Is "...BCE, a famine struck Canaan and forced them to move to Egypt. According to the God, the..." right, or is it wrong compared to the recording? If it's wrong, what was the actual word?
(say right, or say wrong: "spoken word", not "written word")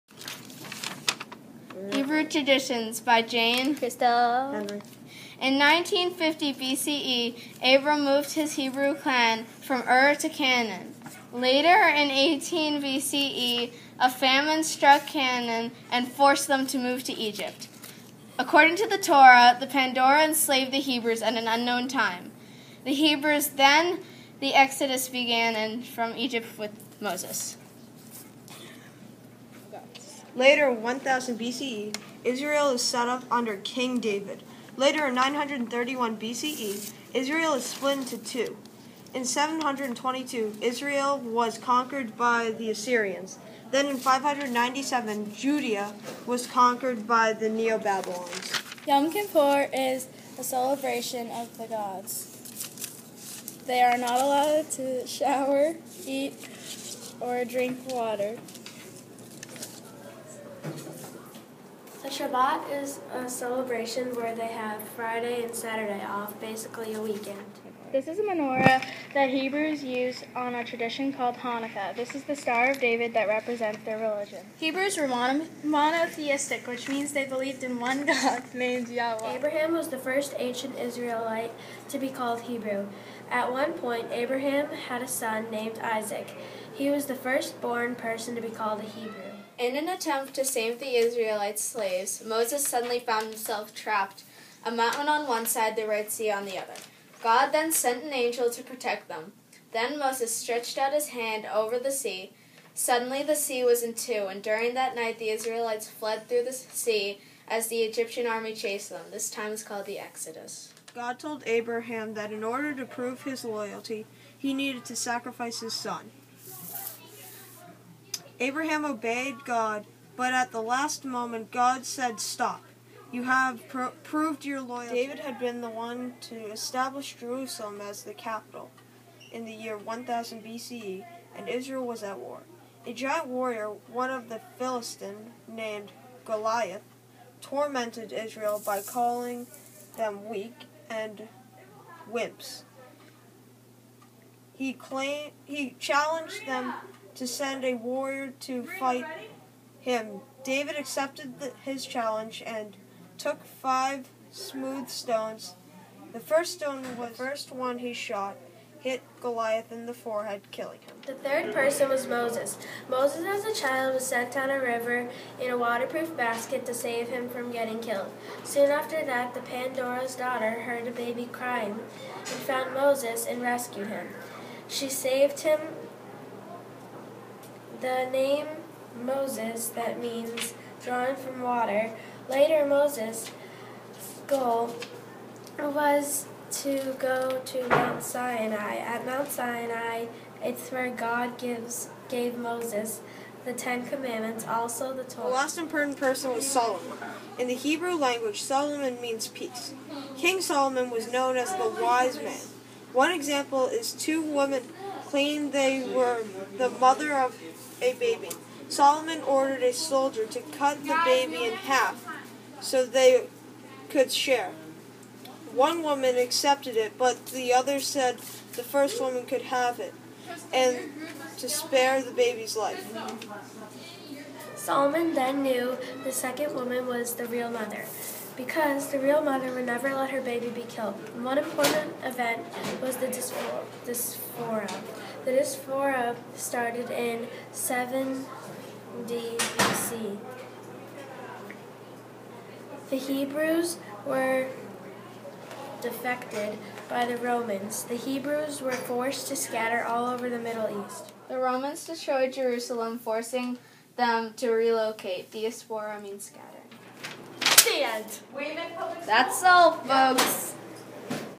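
wrong: "Torah", not "God".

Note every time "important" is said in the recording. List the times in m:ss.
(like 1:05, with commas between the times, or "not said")
3:15, 3:51.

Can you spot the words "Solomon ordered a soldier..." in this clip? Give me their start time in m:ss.
3:28.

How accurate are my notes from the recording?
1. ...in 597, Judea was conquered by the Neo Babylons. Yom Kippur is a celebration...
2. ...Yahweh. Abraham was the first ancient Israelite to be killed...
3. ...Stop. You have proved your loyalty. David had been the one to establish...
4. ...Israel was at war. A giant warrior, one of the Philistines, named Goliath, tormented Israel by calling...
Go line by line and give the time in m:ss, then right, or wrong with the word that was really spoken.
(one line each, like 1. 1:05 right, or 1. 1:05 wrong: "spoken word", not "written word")
1. 0:43 right
2. 1:18 wrong: "called", not "killed"
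3. 2:02 right
4. 2:11 right.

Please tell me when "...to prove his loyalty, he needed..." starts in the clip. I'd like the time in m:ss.
1:52.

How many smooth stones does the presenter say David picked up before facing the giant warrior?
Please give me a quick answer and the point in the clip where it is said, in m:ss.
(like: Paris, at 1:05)
5, at 2:33.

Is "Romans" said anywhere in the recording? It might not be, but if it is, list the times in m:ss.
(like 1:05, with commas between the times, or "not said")
4:07, 4:11.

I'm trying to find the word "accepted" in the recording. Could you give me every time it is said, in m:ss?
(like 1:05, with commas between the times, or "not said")
2:30, 3:36.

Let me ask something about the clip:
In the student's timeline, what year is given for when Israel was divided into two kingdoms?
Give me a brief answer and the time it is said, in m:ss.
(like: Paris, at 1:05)
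931 BCE, at 0:35.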